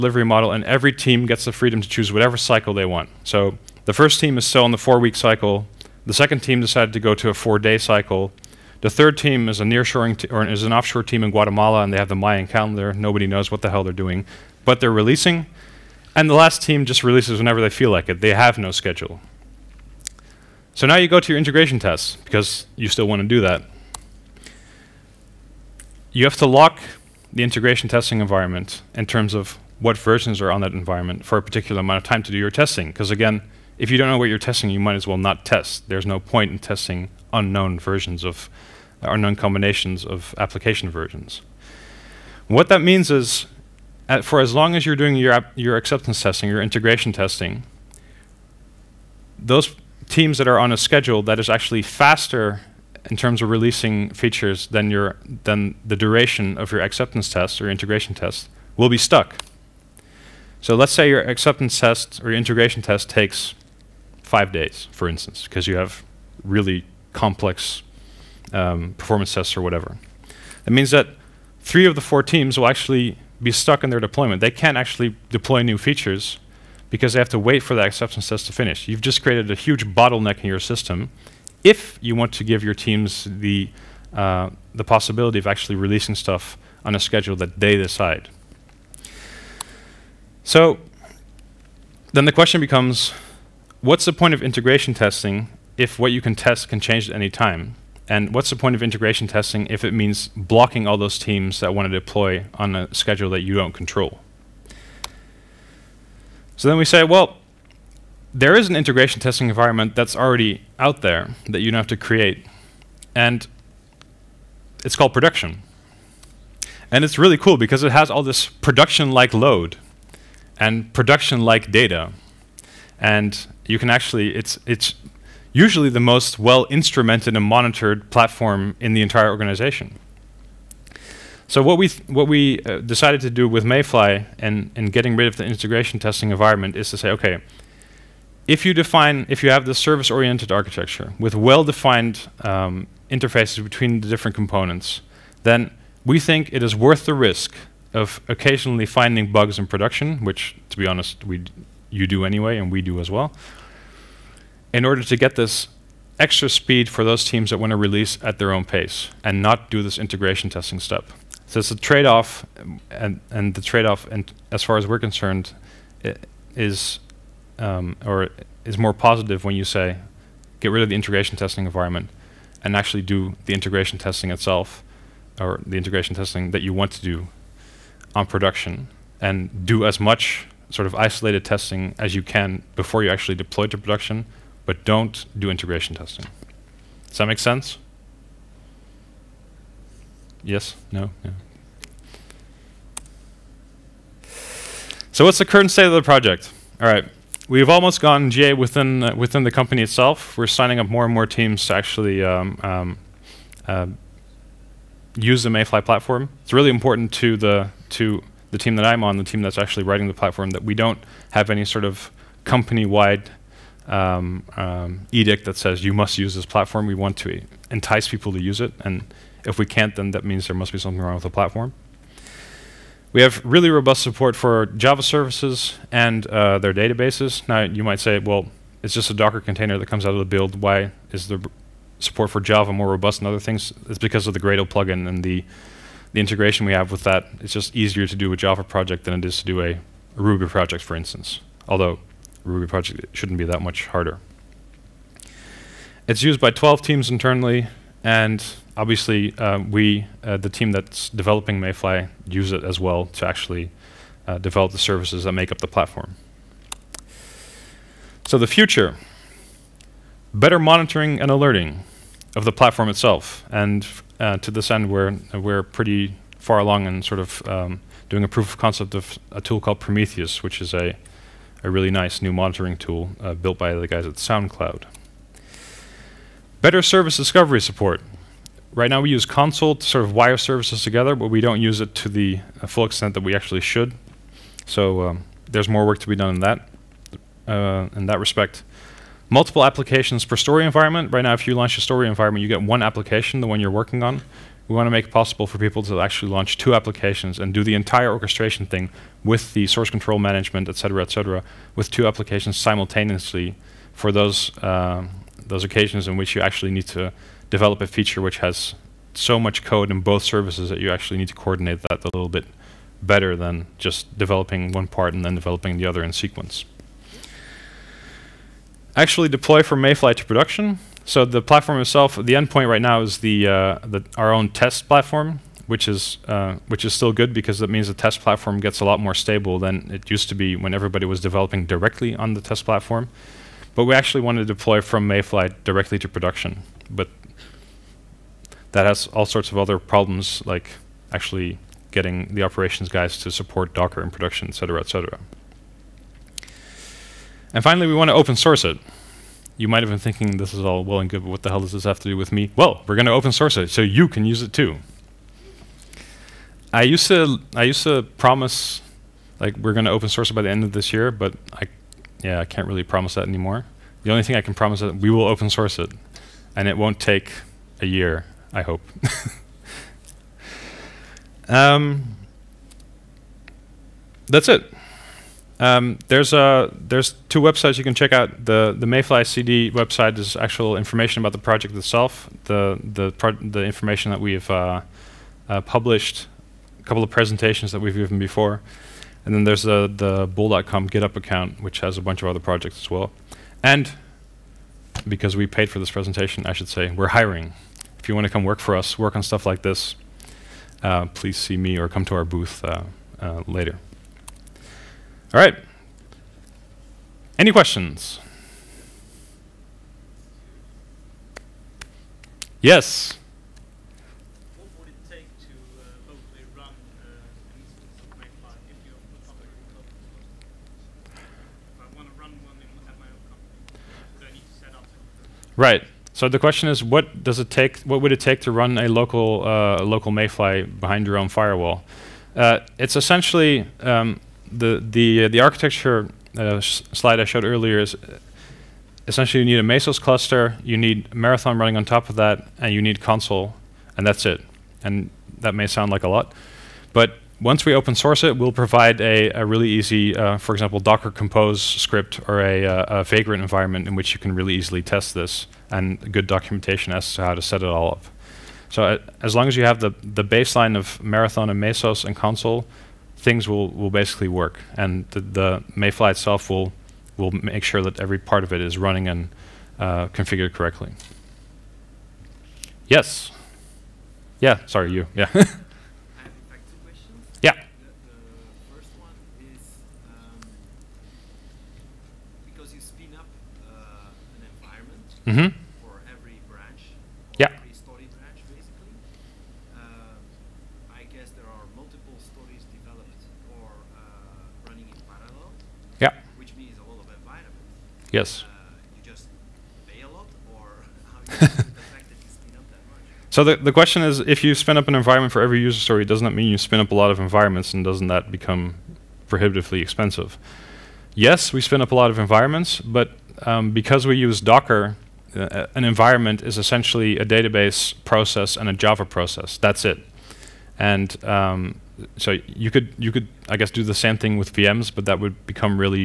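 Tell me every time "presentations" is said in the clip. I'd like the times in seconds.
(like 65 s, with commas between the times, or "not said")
387 s, 395 s.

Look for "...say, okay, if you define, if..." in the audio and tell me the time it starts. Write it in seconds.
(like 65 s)
136 s.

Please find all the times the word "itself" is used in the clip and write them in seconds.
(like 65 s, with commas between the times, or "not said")
174 s, 199 s, 262 s, 321 s, 381 s, 466 s.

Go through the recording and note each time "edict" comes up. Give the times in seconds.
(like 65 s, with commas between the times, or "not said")
215 s.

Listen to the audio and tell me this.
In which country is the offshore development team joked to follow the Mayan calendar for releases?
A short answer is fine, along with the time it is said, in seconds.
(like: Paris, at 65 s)
Guatemala, at 11 s.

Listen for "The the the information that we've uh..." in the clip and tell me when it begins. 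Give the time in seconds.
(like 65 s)
382 s.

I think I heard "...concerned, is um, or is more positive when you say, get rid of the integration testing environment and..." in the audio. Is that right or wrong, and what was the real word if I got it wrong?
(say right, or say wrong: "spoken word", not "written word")
right.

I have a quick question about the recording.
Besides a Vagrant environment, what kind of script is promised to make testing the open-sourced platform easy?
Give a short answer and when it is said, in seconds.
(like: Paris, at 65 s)
Docker Compose, at 450 s.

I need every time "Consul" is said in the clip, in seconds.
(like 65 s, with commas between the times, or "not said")
279 s, 443 s, 462 s.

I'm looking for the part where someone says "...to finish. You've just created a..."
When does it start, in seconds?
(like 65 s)
78 s.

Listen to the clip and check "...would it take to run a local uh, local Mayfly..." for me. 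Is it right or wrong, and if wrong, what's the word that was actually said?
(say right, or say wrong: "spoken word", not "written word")
right.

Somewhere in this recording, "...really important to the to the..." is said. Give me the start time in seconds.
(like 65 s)
206 s.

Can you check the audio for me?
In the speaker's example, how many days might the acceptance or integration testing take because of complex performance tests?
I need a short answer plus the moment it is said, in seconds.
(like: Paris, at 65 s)
5 days, at 64 s.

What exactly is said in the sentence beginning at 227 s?
Now, you might say, well, it's just a Docker container that comes out of the build.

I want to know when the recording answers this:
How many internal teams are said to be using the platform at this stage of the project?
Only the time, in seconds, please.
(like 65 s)
246 s.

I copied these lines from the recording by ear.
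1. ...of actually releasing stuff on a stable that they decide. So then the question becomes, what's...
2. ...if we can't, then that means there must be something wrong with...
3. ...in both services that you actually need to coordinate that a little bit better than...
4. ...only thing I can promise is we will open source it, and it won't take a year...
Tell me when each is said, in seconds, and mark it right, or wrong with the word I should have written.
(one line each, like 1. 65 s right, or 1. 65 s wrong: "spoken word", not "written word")
1. 85 s wrong: "schedule", not "stable"
2. 219 s right
3. 309 s right
4. 364 s right.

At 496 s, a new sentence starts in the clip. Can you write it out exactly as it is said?
which means a lot of environment.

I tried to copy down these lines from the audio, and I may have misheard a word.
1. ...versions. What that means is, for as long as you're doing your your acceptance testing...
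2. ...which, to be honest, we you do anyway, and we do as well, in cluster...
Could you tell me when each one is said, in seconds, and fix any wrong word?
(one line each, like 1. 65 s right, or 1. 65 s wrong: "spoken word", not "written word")
1. 40 s right
2. 150 s wrong: "order", not "cluster".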